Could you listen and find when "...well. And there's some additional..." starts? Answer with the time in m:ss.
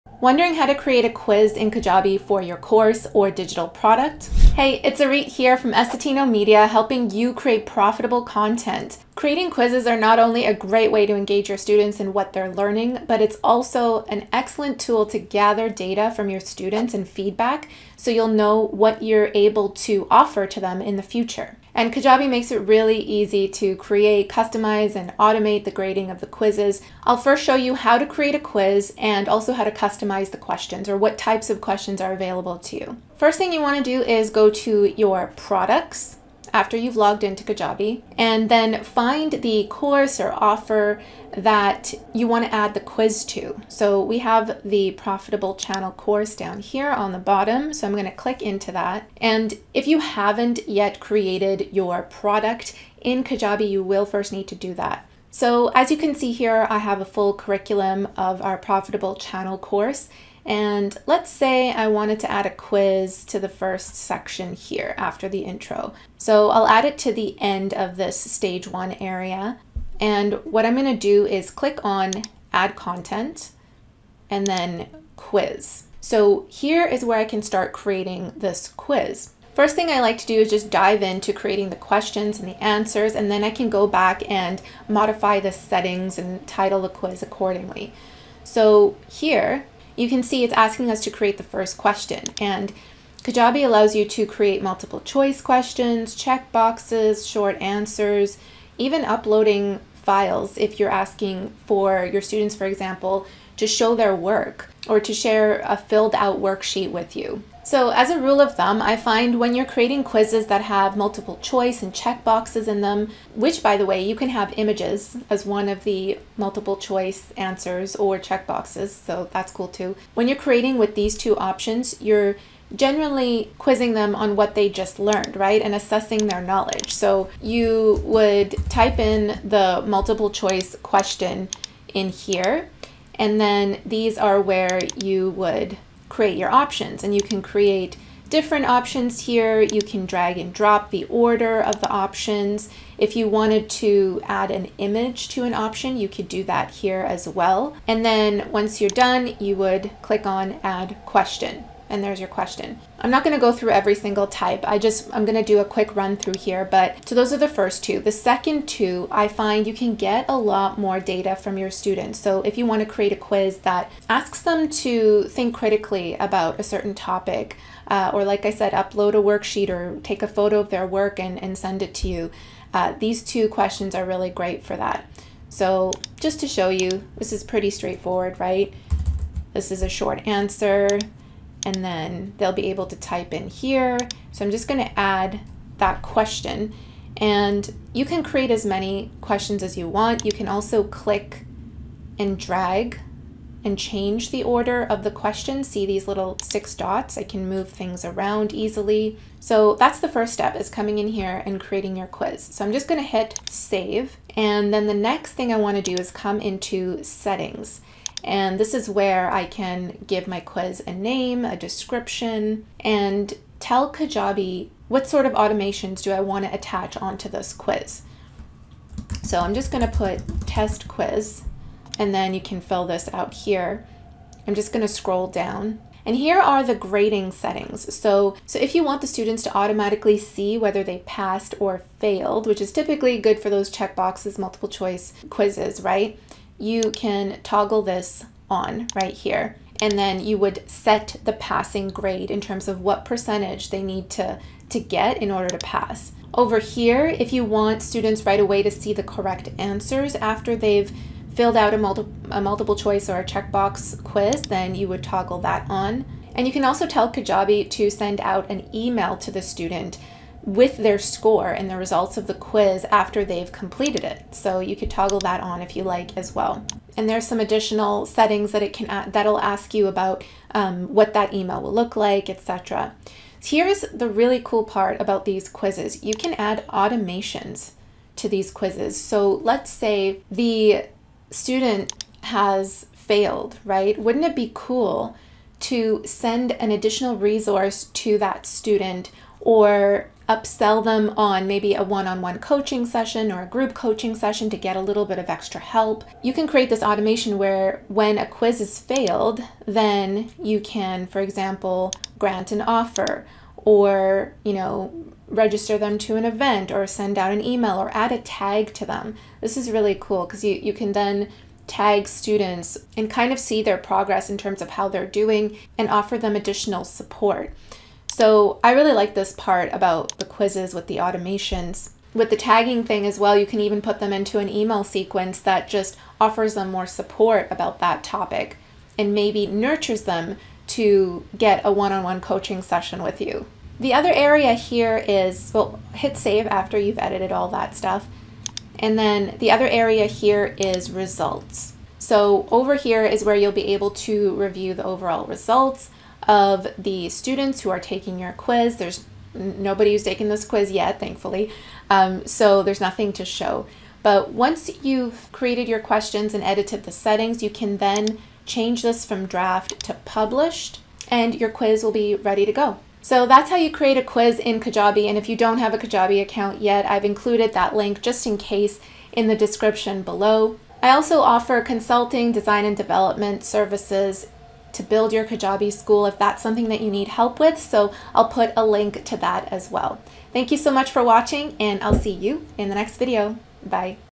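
4:26.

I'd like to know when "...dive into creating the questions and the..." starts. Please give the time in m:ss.
1:20.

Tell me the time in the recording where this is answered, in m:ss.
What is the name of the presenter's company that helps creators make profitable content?
0:05.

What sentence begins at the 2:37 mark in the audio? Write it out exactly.
The second two, I find you can get a lot more data from your students.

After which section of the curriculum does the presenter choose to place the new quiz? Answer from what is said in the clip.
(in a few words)
Stage one.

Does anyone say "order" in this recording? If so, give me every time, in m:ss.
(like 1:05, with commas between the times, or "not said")
2:21, 3:14, 4:05.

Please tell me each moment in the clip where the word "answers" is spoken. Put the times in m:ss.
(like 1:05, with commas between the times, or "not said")
1:22, 1:37, 1:57, 3:00, 4:09.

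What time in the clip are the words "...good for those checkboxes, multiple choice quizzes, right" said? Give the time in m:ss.
3:53.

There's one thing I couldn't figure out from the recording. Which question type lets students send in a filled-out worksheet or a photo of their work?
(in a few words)
Uploading files.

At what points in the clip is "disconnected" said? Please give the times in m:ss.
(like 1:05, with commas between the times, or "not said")
not said.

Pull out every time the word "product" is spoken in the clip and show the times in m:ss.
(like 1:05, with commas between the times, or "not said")
0:03, 0:35, 0:52.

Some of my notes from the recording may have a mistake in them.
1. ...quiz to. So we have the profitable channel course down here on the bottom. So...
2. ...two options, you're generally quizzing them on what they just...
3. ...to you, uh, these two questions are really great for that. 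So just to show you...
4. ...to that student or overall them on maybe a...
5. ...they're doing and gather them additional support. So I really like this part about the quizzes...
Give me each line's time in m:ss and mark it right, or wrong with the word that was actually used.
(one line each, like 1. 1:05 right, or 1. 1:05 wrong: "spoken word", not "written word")
1. 0:42 right
2. 2:01 right
3. 2:51 right
4. 4:47 wrong: "upsell", not "overall"
5. 5:14 wrong: "offer", not "gather".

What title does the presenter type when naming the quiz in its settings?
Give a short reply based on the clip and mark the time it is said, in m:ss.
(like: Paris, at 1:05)
Test quiz, at 3:40.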